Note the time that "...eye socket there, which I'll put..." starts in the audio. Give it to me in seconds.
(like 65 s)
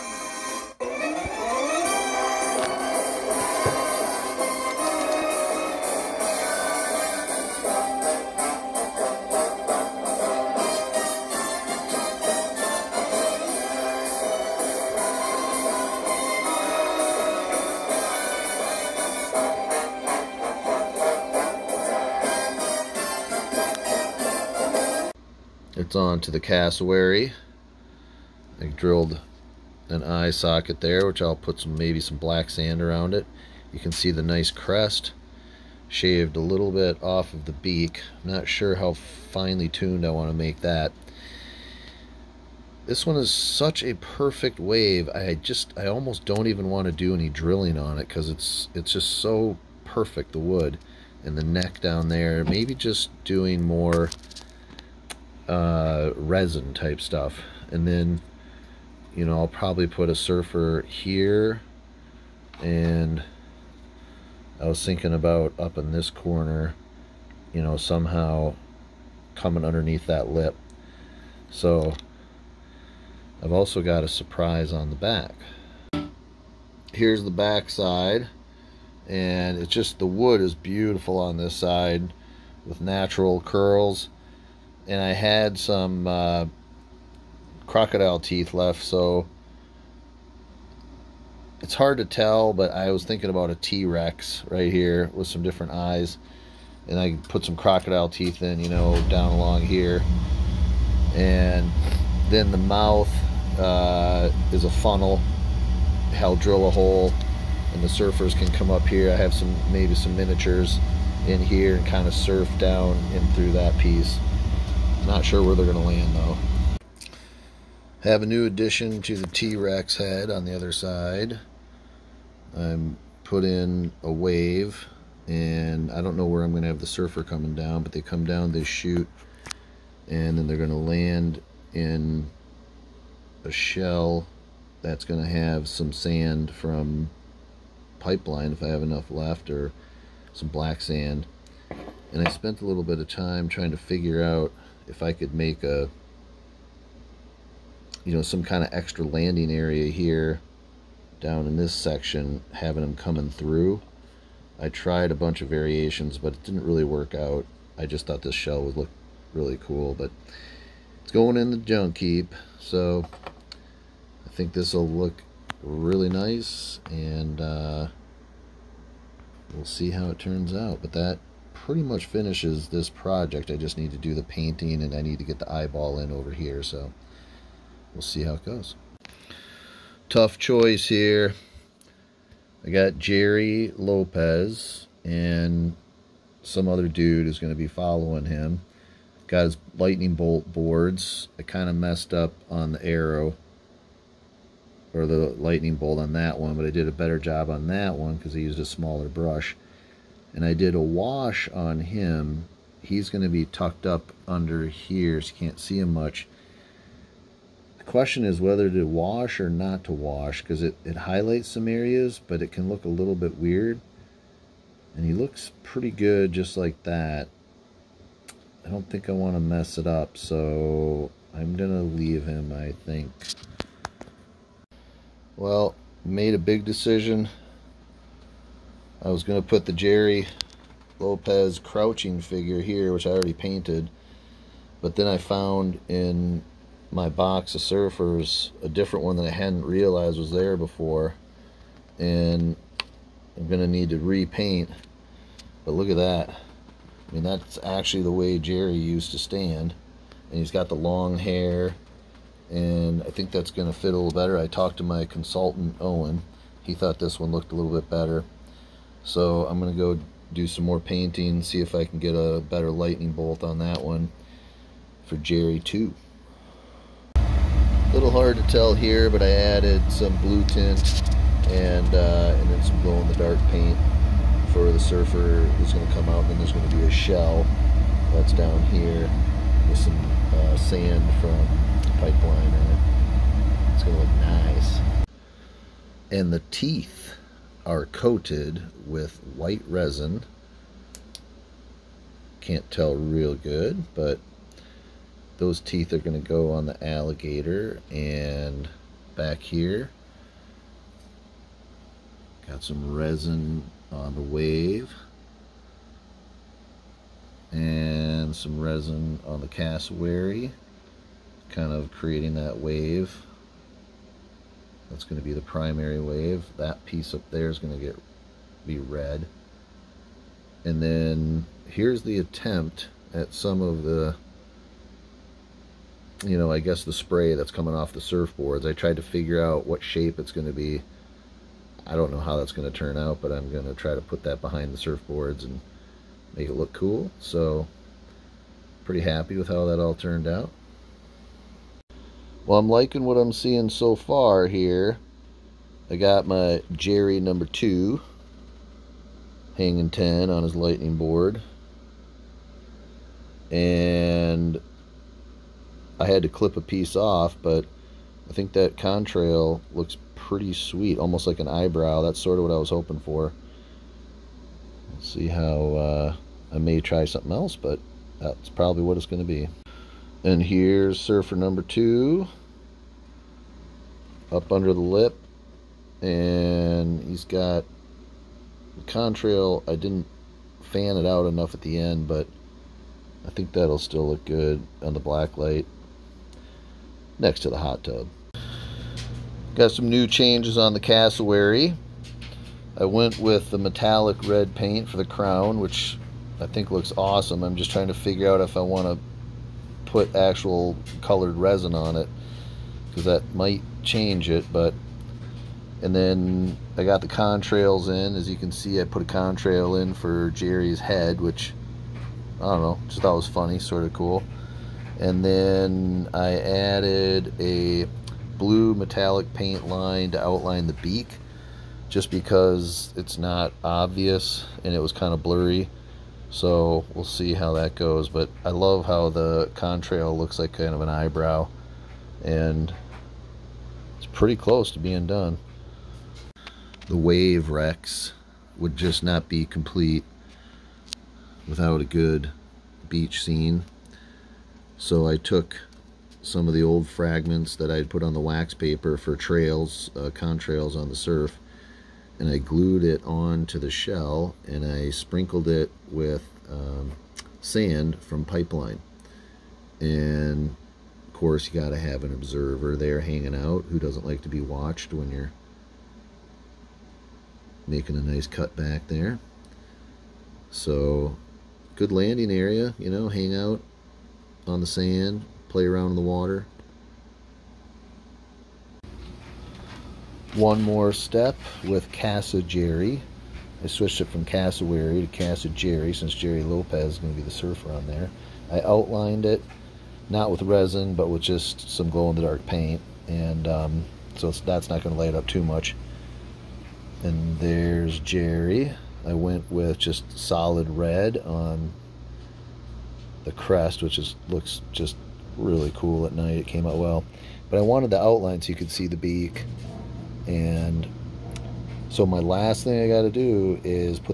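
30 s.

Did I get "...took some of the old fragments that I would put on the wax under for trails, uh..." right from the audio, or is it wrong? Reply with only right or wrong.
wrong.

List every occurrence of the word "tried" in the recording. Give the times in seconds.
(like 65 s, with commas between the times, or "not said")
154 s, 328 s.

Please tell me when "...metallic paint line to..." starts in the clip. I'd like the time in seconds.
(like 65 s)
418 s.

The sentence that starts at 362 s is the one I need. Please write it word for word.
That's sort of what I was hoping for.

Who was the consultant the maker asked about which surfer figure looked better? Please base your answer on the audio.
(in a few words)
Owen.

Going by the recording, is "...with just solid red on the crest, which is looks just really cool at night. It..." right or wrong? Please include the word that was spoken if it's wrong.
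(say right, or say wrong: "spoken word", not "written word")
right.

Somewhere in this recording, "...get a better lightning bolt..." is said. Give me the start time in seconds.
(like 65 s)
261 s.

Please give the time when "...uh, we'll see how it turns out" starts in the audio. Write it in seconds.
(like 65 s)
167 s.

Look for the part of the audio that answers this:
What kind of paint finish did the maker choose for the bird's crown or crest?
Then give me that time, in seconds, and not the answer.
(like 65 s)
393 s.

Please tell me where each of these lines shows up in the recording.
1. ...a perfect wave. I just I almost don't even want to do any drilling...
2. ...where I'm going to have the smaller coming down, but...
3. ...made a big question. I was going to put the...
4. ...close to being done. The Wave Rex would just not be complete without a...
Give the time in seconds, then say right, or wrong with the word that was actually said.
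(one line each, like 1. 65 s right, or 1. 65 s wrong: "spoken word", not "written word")
1. 43 s right
2. 126 s wrong: "surfer", not "smaller"
3. 226 s wrong: "decision", not "question"
4. 434 s right.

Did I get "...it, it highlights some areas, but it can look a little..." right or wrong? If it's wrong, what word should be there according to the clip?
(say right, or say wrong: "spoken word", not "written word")
right.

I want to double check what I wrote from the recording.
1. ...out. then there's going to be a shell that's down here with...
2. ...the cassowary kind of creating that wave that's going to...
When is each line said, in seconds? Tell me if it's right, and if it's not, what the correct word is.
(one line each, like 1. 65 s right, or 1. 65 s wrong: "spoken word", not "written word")
1. 276 s right
2. 309 s right.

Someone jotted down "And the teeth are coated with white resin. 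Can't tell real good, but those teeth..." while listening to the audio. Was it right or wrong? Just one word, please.
right.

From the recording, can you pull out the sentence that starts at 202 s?
He's going to be tucked up under here, so you can't see him much.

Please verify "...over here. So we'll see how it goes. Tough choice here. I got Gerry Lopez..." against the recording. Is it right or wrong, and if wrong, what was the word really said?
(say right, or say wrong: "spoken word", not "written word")
right.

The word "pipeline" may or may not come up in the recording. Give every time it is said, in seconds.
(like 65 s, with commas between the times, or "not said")
137 s, 281 s, 458 s.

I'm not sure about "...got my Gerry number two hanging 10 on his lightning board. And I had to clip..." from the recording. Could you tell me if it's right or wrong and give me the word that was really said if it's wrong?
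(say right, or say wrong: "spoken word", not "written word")
right.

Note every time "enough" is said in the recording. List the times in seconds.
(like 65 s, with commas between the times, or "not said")
138 s, 381 s.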